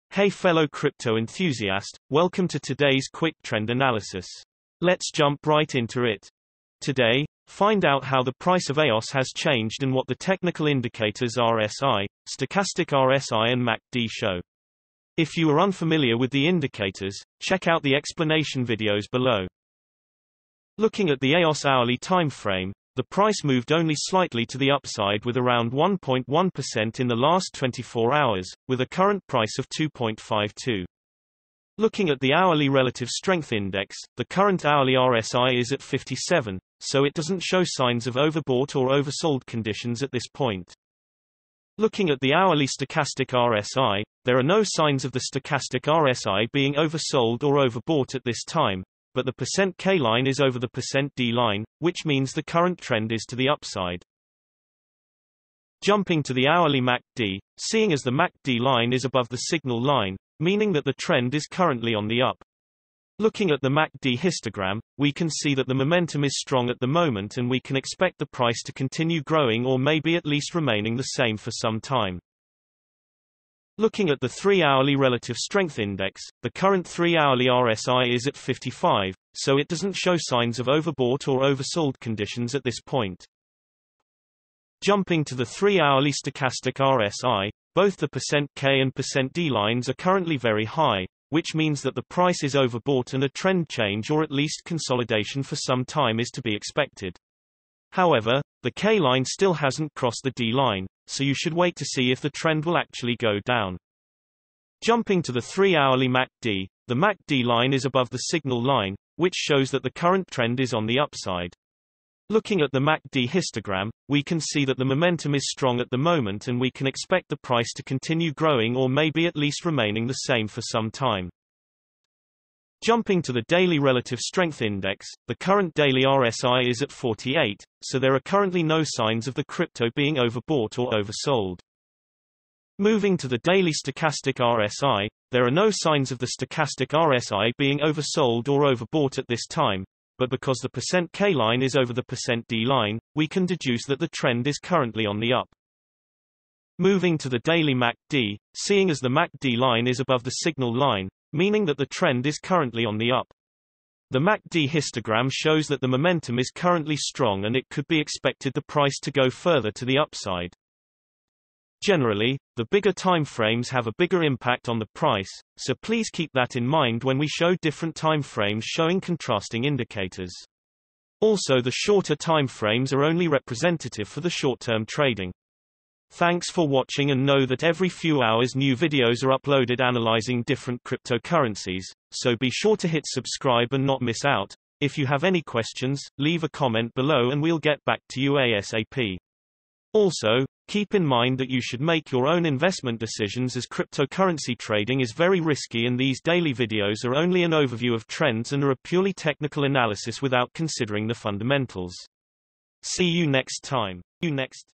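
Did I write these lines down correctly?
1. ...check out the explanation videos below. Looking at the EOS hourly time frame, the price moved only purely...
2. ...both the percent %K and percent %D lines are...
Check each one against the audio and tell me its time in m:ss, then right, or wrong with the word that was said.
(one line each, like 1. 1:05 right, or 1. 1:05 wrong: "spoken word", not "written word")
1. 0:17 wrong: "slightly", not "purely"
2. 1:27 right.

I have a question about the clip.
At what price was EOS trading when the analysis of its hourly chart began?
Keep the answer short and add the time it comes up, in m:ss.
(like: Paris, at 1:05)
2.52, at 0:29.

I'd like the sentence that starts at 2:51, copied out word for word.
Also the shorter time frames are only representative for the short-term trading.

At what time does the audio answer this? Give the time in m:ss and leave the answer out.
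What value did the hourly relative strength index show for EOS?
0:35.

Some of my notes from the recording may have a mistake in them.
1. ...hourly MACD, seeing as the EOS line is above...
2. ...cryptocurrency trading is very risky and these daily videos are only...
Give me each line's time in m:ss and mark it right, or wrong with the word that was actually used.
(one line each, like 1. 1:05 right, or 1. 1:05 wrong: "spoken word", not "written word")
1. 0:56 wrong: "MACD", not "EOS"
2. 3:13 right.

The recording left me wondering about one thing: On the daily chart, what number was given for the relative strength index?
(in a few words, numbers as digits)
48.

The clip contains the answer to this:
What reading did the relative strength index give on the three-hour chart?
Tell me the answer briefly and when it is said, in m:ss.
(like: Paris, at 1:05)
55, at 1:18.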